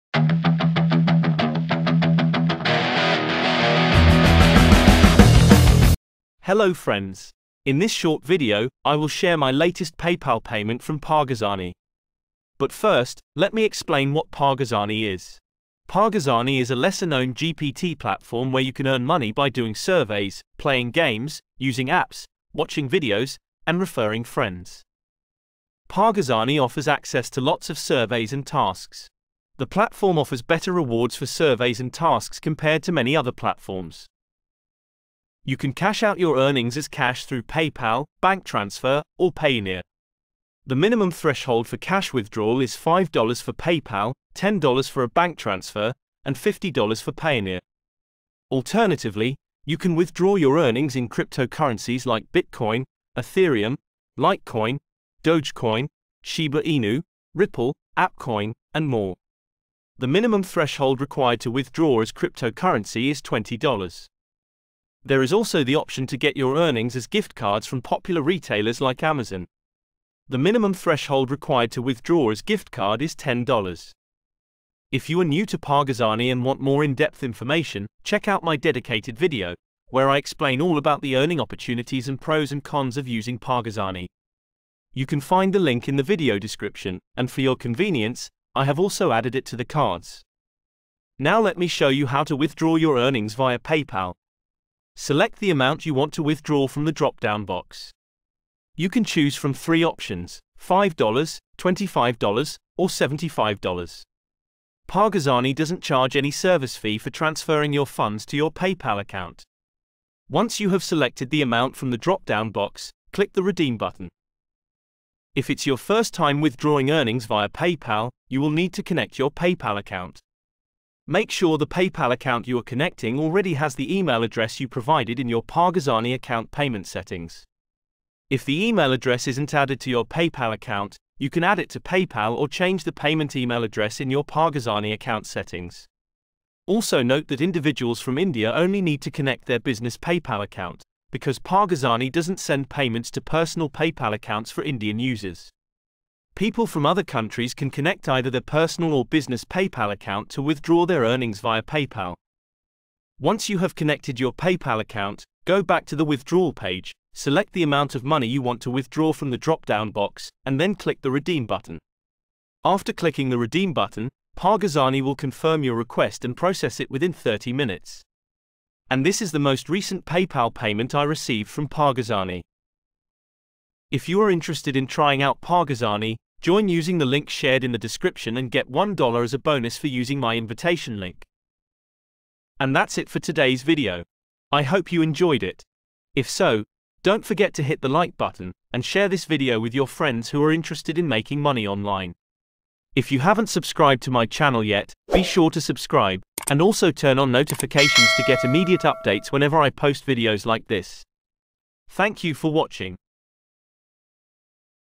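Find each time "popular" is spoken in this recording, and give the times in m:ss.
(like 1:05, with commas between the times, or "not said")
1:07.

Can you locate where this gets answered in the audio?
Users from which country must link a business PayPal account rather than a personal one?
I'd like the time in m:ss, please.
2:18.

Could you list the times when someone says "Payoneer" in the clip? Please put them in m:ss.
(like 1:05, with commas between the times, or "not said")
0:39, 0:47.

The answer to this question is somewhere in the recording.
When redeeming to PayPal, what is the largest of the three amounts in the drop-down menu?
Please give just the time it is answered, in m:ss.
1:42.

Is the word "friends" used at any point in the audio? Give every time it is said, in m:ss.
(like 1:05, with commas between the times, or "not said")
0:06, 0:24, 3:09.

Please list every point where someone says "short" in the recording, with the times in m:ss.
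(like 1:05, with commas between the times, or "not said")
0:07.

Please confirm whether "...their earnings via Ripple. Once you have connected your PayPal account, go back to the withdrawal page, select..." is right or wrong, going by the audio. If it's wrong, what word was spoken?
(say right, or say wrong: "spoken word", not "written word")
wrong: "PayPal", not "Ripple".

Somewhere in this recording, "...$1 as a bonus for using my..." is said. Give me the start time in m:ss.
2:58.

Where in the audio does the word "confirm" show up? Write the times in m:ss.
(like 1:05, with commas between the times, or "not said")
2:45.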